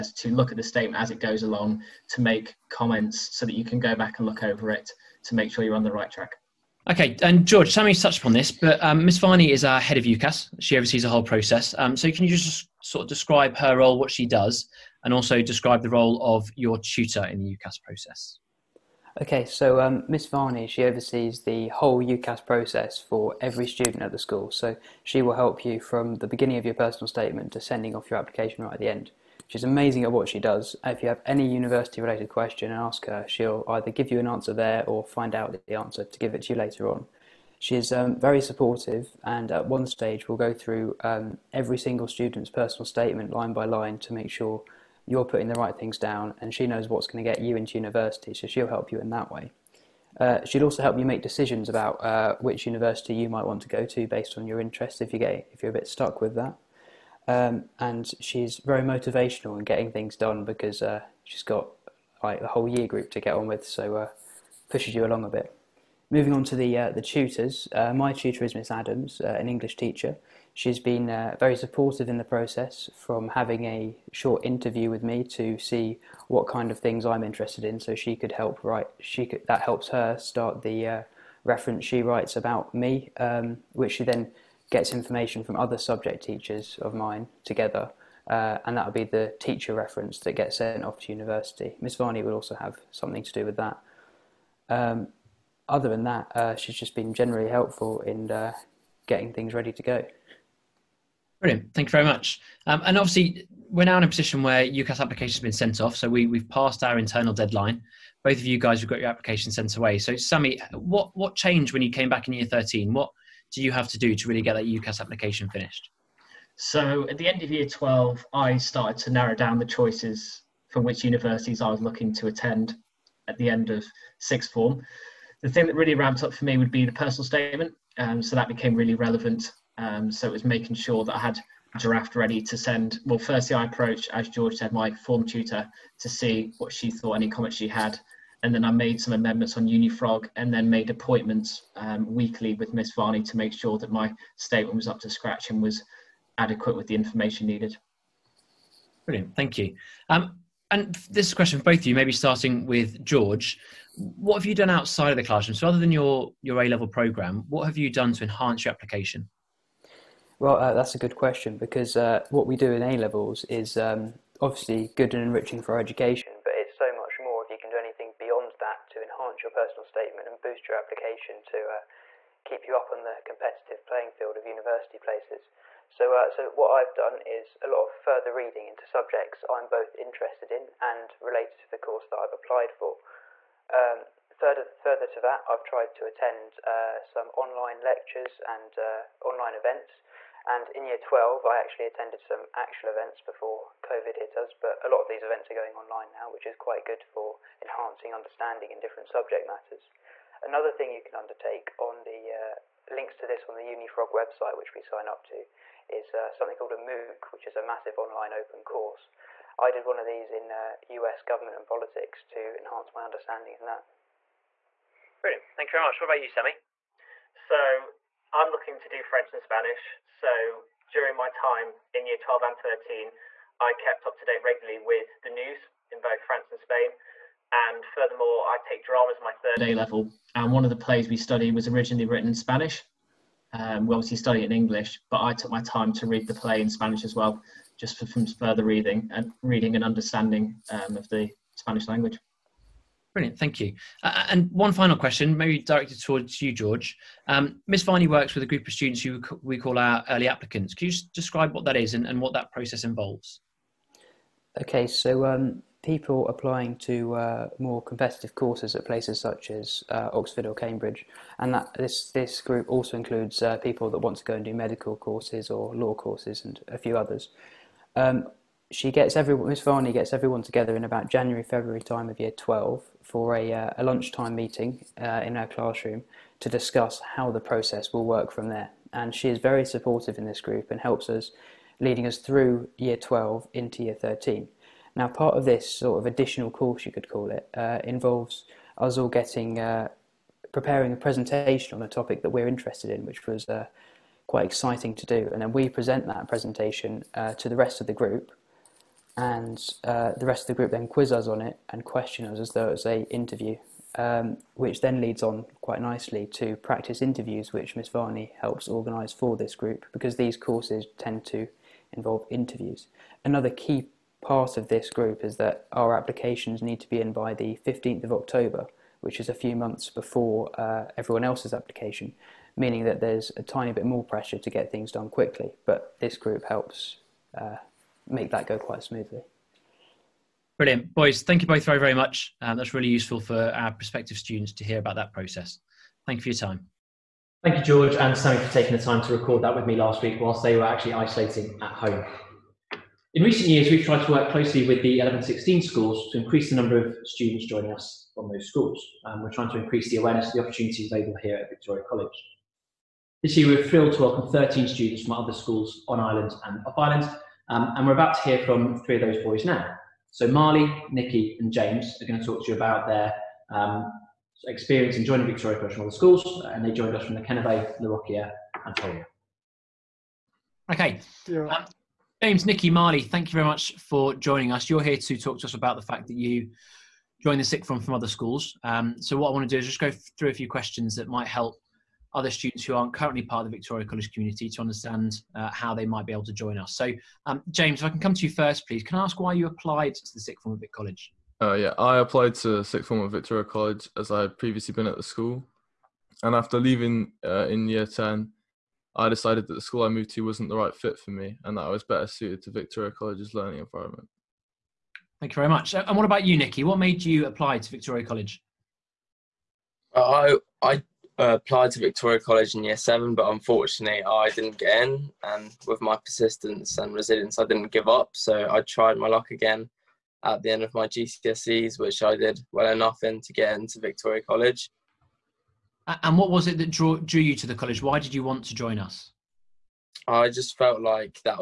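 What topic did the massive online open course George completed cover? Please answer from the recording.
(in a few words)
US government and politics.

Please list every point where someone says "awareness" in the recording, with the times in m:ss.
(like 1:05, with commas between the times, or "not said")
5:49.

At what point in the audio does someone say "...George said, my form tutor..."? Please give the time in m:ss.
2:14.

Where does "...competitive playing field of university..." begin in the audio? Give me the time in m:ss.
2:53.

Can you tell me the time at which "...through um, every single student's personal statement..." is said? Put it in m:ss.
0:40.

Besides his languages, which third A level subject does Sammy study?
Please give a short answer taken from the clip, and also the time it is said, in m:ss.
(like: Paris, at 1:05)
Drama, at 3:48.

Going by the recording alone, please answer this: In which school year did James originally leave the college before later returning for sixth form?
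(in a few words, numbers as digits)
Year 10.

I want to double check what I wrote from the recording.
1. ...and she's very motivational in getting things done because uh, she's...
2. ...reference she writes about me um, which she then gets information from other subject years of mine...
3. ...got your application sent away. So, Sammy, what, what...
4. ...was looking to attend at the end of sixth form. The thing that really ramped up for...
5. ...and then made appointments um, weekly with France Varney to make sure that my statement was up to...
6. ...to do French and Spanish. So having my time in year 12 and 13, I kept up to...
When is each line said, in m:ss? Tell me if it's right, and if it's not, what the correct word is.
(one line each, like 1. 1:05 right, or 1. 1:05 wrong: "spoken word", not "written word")
1. 0:57 right
2. 1:21 wrong: "teachers", not "years"
3. 1:48 right
4. 2:01 right
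5. 2:20 wrong: "Miss", not "France"
6. 3:38 wrong: "during", not "having".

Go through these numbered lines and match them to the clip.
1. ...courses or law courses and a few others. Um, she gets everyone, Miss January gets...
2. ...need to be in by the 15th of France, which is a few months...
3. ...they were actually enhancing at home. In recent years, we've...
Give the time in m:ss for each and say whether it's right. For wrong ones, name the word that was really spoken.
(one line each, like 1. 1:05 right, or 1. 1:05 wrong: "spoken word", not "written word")
1. 4:24 wrong: "Varney", not "January"
2. 5:16 wrong: "October", not "France"
3. 5:40 wrong: "isolating", not "enhancing".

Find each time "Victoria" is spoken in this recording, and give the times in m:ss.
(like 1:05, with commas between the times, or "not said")
5:51, 6:05, 6:23, 6:33, 6:42, 6:47, 6:51, 7:03.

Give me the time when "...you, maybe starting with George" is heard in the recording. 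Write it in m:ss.
2:31.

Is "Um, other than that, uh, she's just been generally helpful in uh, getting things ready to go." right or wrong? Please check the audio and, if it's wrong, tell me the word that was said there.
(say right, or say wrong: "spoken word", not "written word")
right.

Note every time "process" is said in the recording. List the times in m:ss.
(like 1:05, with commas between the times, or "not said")
0:11, 0:17, 0:22, 1:12, 4:12, 4:37, 5:35.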